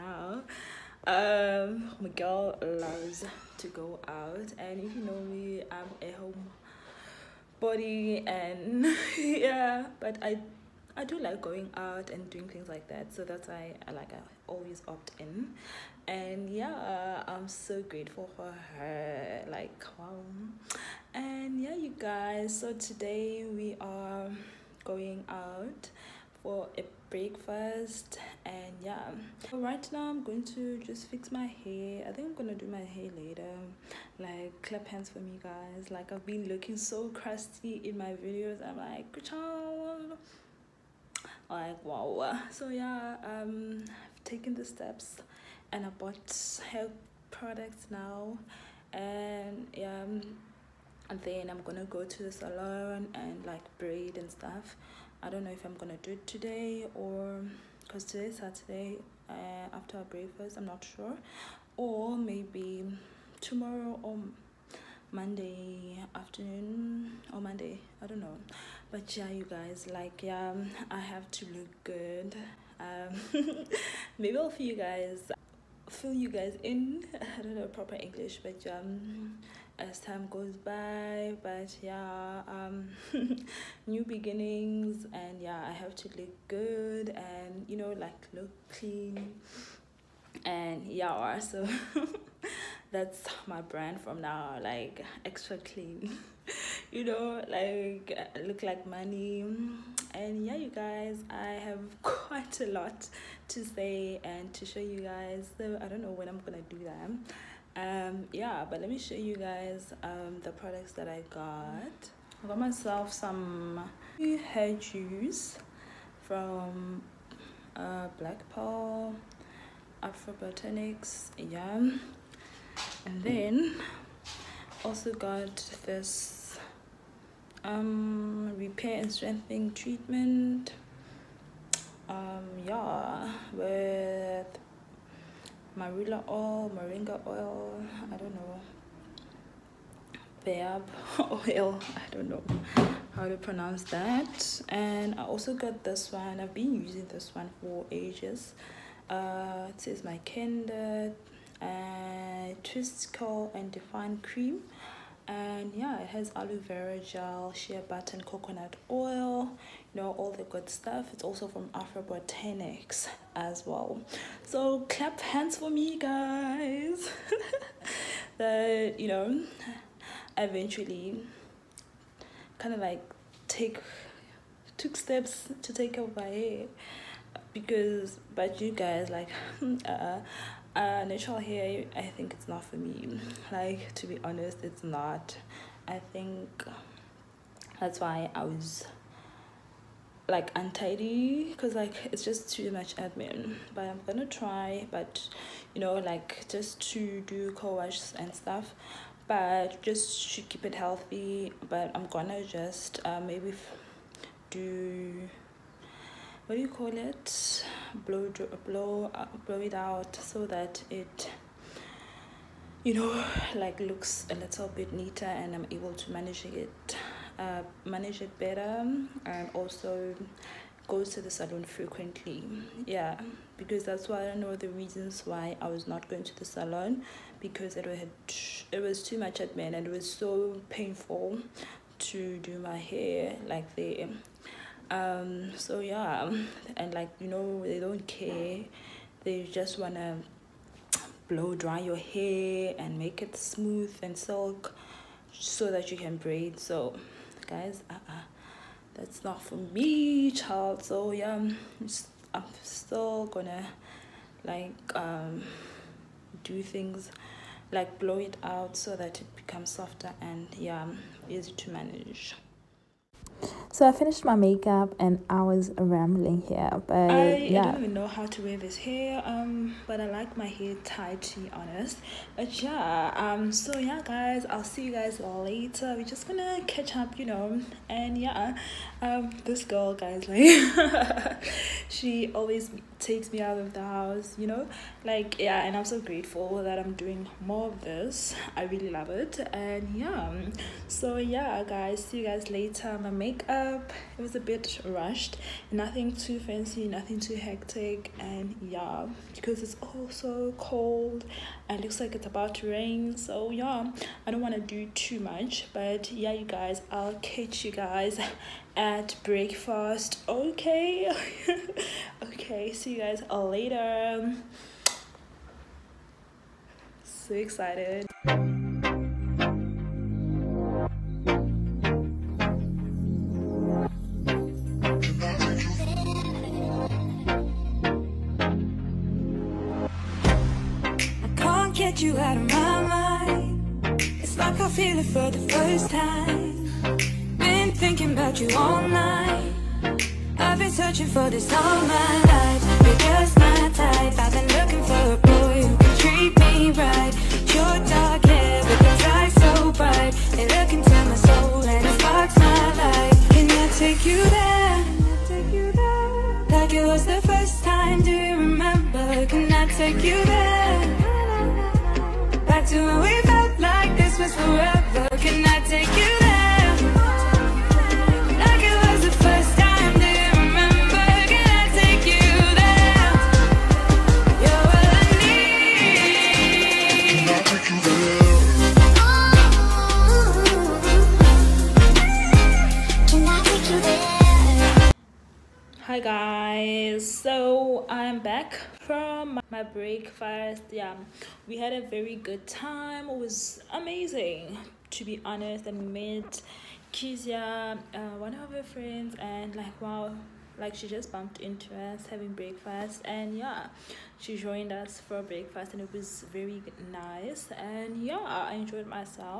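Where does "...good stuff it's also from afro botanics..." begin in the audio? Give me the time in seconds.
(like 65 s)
160 s.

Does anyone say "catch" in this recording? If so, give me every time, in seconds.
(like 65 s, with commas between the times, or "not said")
276 s, 307 s.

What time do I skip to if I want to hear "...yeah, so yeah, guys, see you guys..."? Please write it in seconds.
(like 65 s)
289 s.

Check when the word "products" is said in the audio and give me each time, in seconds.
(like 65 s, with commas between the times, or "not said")
47 s, 110 s.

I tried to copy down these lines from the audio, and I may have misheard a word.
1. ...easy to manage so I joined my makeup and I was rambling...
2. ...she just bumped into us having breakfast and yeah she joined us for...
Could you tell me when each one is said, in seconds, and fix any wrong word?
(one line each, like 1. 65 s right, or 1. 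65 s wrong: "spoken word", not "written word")
1. 261 s wrong: "finished", not "joined"
2. 400 s right.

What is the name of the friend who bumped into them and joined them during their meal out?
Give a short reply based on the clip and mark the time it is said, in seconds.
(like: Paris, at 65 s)
Kizia, at 396 s.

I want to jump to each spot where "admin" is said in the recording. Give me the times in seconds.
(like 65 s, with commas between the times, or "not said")
192 s, 229 s.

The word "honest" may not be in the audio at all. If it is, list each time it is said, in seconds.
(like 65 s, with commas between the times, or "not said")
184 s, 271 s, 395 s.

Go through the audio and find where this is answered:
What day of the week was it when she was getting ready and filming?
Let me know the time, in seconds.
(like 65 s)
58 s.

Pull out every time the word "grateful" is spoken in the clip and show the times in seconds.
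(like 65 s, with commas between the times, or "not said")
17 s, 285 s.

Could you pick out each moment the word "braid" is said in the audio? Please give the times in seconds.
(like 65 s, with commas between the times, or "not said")
53 s, 246 s.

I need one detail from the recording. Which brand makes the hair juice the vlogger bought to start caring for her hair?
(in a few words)
Black Pearl Afro Botanics.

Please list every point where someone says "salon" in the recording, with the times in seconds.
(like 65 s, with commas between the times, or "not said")
52 s, 221 s, 226 s.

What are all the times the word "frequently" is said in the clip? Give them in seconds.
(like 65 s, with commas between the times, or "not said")
221 s.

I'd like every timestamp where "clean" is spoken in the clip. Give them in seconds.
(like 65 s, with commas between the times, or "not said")
88 s, 95 s.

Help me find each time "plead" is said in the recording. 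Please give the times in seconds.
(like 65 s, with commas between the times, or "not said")
not said.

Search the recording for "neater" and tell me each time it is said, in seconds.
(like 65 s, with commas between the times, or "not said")
214 s.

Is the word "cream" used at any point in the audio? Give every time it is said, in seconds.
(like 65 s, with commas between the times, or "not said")
154 s.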